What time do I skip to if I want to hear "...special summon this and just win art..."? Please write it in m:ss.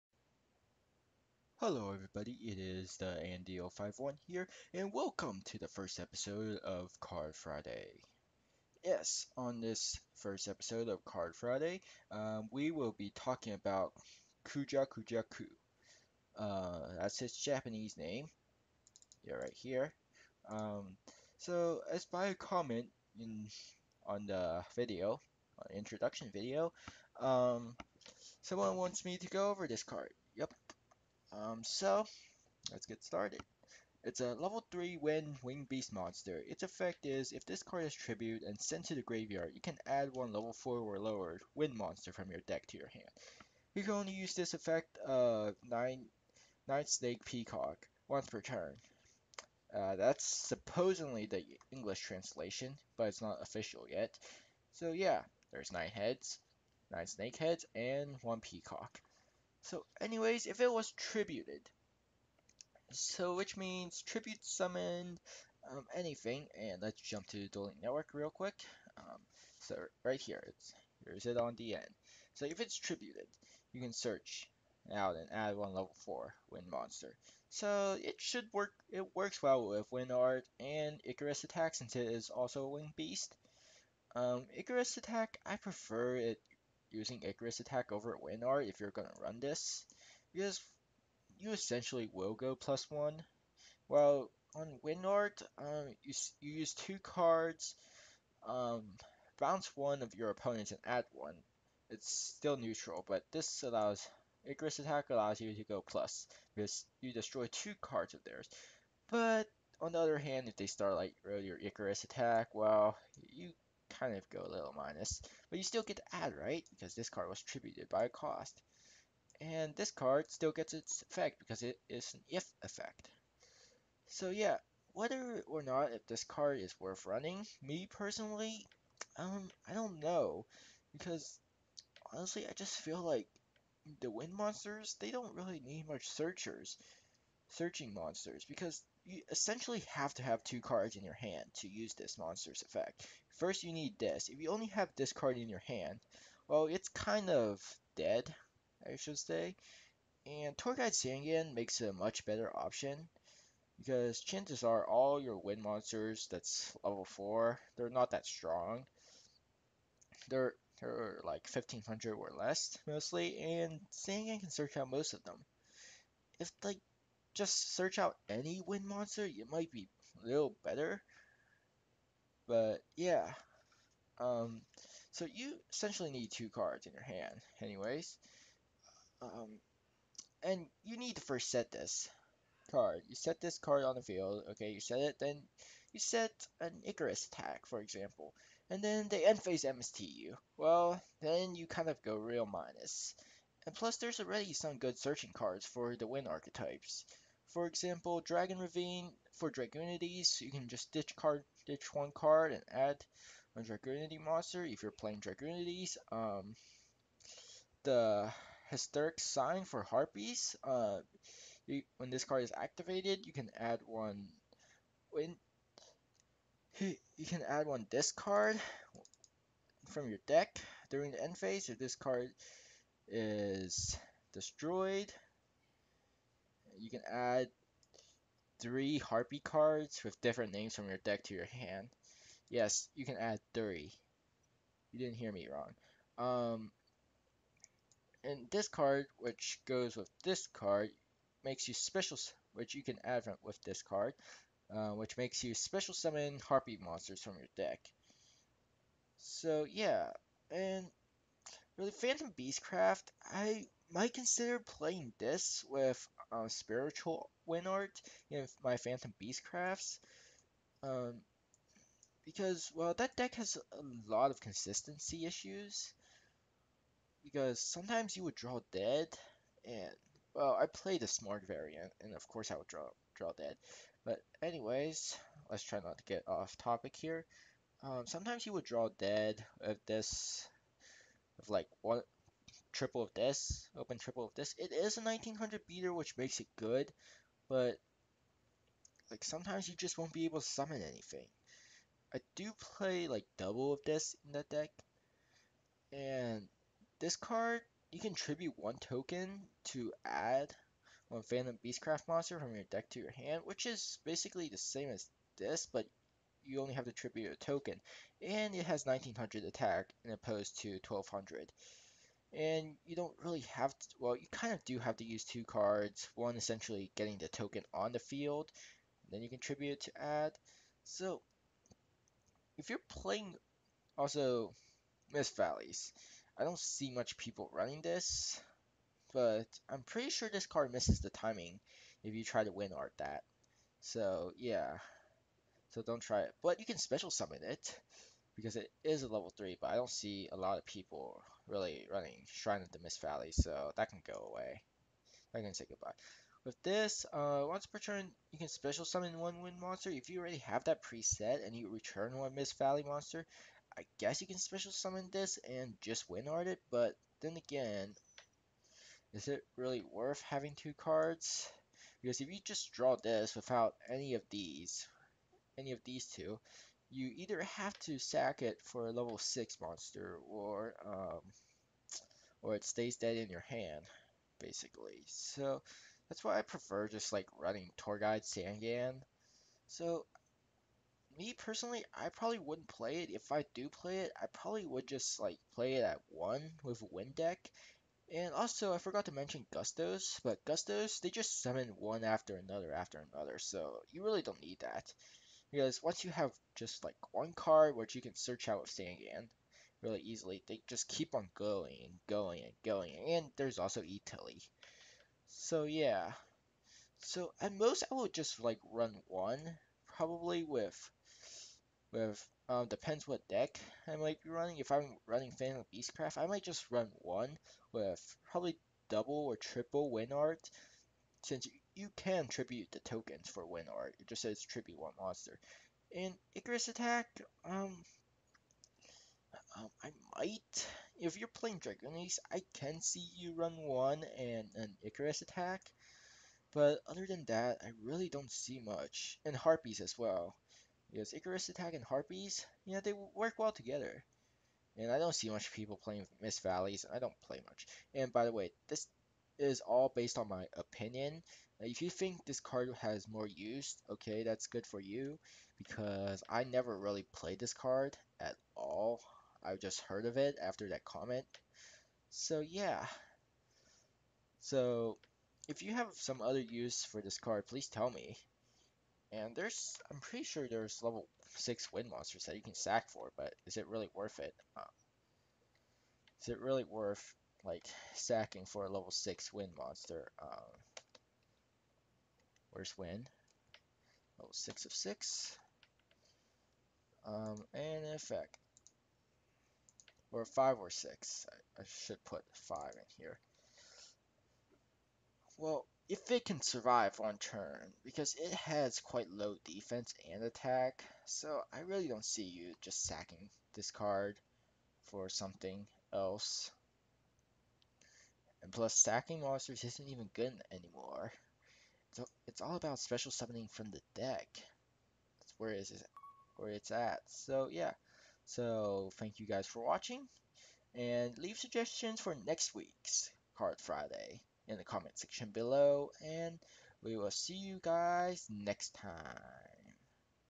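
5:54.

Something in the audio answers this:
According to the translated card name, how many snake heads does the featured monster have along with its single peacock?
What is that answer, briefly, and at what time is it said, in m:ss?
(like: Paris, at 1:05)
9, at 0:56.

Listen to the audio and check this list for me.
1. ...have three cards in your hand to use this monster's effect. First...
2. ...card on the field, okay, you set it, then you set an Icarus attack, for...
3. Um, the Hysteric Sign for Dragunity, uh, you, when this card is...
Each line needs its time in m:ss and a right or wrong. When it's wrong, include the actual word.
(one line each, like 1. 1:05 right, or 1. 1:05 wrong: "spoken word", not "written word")
1. 2:20 wrong: "two", not "three"
2. 3:03 right
3. 3:26 wrong: "Harpies", not "Dragunity".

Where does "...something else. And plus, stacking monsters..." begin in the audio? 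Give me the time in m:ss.
8:25.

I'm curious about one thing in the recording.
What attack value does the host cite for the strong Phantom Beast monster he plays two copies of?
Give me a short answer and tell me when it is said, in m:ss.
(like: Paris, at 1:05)
1900, at 4:45.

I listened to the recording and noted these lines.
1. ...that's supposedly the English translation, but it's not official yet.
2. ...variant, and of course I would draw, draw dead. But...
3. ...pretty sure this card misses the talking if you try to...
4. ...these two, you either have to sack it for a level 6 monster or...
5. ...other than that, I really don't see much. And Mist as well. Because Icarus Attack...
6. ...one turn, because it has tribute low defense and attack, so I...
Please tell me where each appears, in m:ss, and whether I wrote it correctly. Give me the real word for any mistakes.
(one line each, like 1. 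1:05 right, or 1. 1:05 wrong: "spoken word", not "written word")
1. 0:49 right
2. 4:31 right
3. 5:29 wrong: "timing", not "talking"
4. 6:05 right
5. 7:16 wrong: "Harpies", not "Mist"
6. 8:16 wrong: "quite", not "tribute".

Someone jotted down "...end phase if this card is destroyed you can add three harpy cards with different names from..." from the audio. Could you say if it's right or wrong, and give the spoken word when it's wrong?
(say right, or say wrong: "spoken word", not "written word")
right.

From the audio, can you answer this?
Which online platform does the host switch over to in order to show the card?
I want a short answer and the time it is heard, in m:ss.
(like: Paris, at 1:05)
Dueling Network, at 1:07.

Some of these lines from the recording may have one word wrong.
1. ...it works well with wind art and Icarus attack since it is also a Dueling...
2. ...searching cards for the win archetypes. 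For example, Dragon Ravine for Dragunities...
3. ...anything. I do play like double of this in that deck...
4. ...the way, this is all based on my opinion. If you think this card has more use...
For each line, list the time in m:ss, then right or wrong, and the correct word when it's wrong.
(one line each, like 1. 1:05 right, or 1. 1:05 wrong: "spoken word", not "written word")
1. 1:18 wrong: "Wing", not "Dueling"
2. 3:14 right
3. 4:50 right
4. 7:28 right.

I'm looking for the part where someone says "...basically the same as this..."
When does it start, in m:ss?
5:04.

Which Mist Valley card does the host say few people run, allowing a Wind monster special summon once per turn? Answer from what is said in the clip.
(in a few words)
Shrine of the Mist Valley.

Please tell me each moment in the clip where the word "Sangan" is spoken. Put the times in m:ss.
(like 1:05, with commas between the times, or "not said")
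2:30, 2:43, 6:18, 6:38.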